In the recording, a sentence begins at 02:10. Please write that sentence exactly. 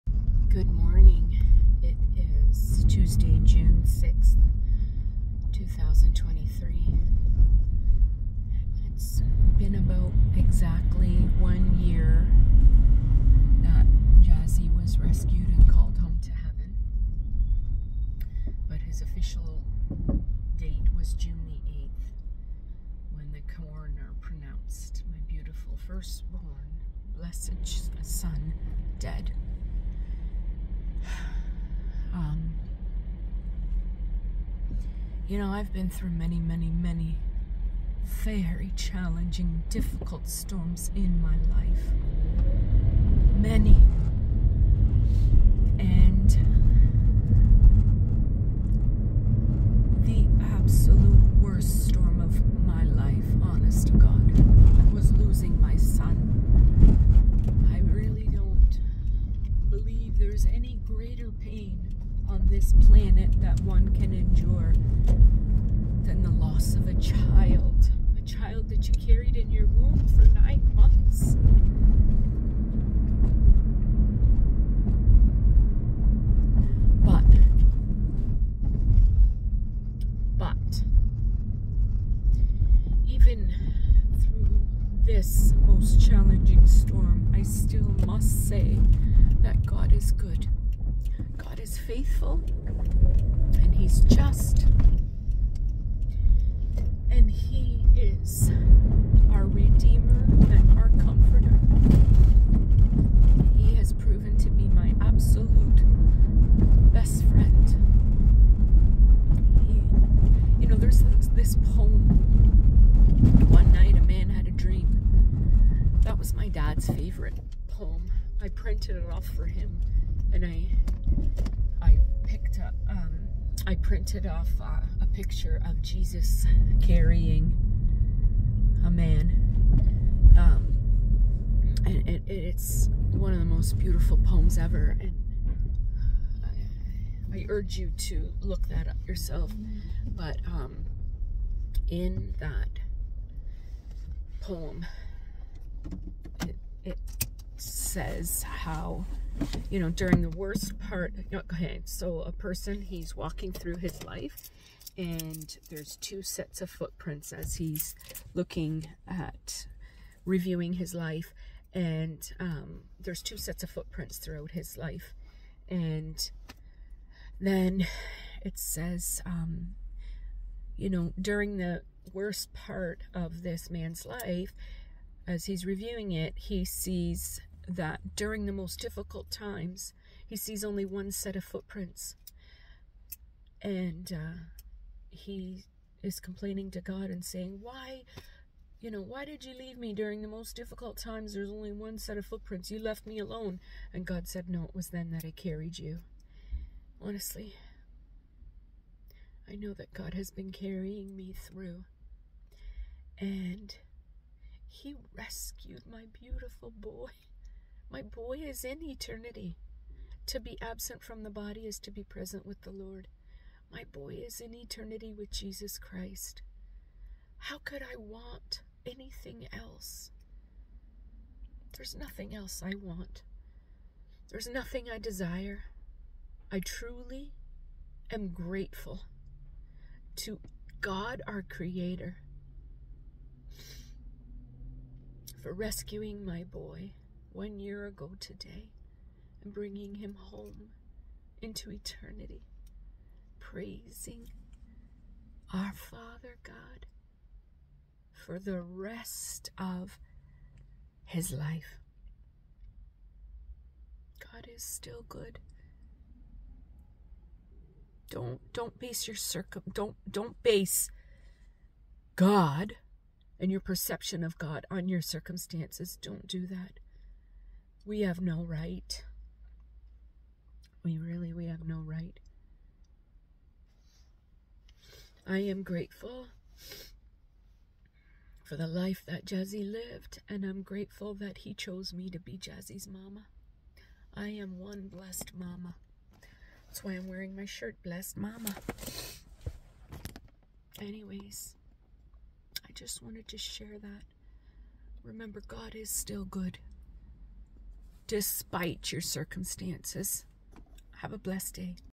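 Um, and it, it's one of the most beautiful poems ever.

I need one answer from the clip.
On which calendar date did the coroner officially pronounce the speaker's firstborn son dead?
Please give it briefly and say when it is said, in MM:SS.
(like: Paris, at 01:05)
June 8, at 00:21.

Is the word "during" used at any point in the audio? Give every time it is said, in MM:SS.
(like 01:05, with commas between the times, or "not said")
02:29, 02:51, 02:58, 03:09.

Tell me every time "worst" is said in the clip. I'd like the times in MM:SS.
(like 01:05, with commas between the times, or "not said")
00:51, 02:30, 02:52.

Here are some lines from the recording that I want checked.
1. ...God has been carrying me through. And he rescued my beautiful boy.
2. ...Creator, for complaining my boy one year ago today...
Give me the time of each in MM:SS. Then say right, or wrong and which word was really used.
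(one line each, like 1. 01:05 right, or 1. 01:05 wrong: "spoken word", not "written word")
1. 03:19 right
2. 03:51 wrong: "rescuing", not "complaining".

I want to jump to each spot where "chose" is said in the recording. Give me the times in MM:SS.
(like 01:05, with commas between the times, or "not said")
04:41.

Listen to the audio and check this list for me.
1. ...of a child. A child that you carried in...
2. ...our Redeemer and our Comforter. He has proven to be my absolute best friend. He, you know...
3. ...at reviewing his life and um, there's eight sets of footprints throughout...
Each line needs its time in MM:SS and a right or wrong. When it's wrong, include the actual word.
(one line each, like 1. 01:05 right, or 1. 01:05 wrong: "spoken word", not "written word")
1. 01:06 right
2. 01:39 right
3. 02:39 wrong: "two", not "eight".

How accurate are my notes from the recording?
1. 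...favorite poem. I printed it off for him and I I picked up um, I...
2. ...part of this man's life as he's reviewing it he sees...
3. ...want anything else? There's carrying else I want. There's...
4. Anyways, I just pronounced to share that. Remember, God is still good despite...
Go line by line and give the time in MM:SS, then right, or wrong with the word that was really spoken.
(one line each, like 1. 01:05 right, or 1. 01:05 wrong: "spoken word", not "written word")
1. 01:56 right
2. 02:52 right
3. 03:37 wrong: "nothing", not "carrying"
4. 04:50 wrong: "wanted", not "pronounced".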